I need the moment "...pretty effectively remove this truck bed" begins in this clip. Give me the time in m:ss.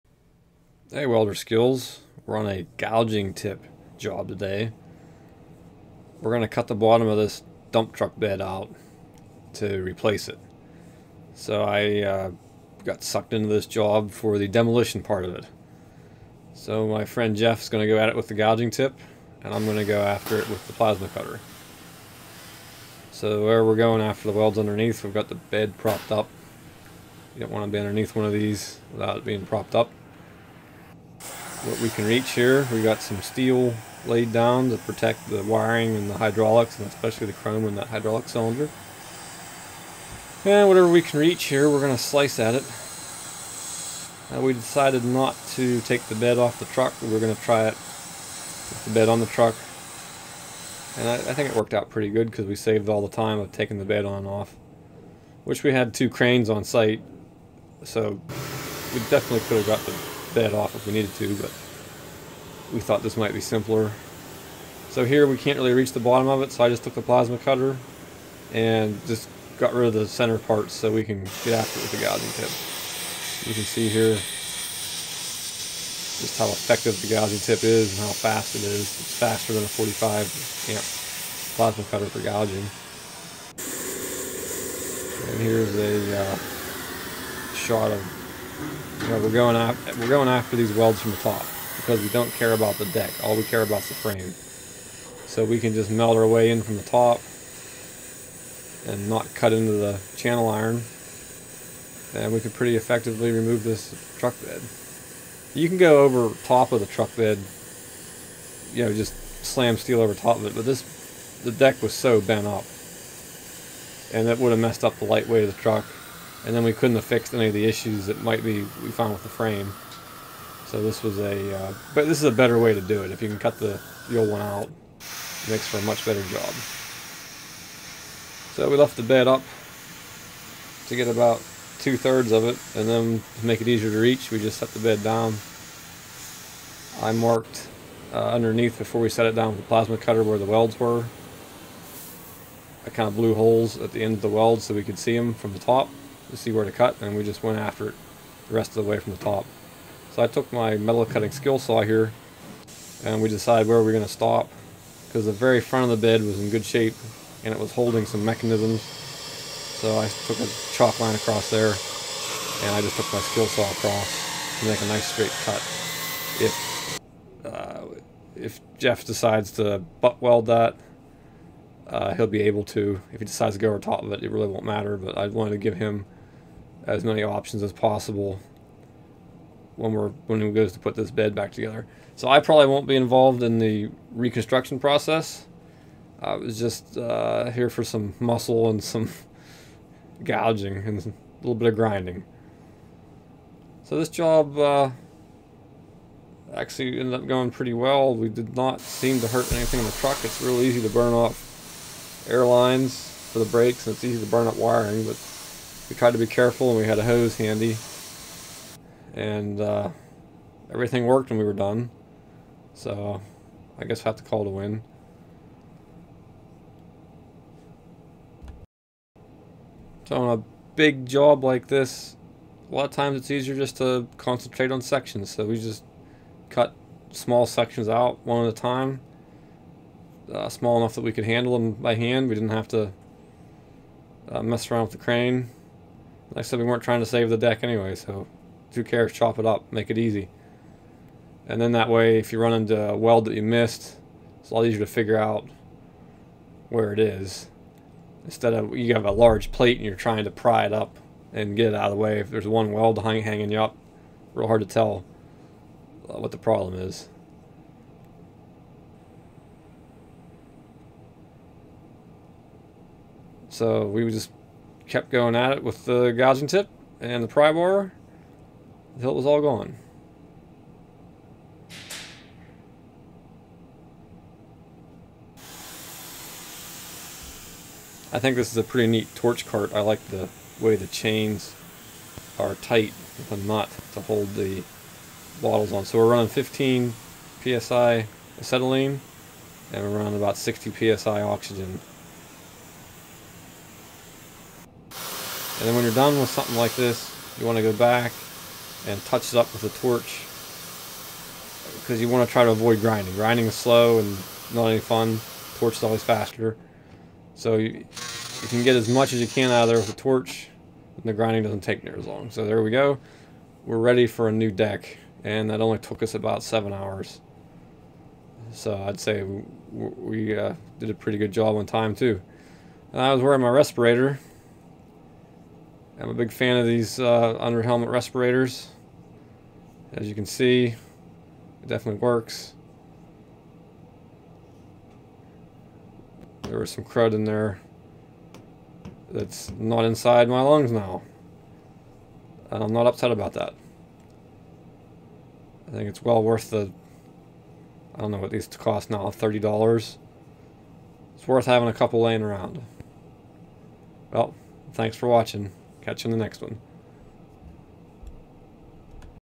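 1:42.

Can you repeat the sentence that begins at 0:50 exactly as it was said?
And I, I think it worked out pretty good because we saved all the time of taking the bed on and off.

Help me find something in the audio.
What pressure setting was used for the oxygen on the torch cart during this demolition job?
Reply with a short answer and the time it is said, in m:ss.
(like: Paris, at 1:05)
60 psi, at 4:50.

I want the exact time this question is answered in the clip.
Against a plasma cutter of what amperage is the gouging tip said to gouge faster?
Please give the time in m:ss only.
1:19.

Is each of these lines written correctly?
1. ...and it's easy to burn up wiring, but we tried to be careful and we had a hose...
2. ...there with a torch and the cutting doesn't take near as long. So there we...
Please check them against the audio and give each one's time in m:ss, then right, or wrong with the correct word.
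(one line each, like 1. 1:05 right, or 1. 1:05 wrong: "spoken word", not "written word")
1. 3:23 right
2. 5:09 wrong: "grinding", not "cutting".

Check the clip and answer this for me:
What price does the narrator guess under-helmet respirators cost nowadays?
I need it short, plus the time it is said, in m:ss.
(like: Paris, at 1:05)
$30, at 5:49.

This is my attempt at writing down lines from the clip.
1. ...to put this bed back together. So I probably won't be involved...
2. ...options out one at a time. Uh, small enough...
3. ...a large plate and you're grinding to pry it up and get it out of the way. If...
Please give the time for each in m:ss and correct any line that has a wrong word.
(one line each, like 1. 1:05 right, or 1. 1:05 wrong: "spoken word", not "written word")
1. 3:00 right
2. 3:47 wrong: "sections", not "options"
3. 4:09 wrong: "trying", not "grinding".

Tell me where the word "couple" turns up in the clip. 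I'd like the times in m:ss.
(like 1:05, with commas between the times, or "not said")
5:51.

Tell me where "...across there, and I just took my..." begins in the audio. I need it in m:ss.
2:41.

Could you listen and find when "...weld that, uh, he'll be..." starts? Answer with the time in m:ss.
2:50.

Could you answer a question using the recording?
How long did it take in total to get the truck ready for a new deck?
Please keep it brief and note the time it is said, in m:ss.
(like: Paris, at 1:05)
7 hours, at 5:16.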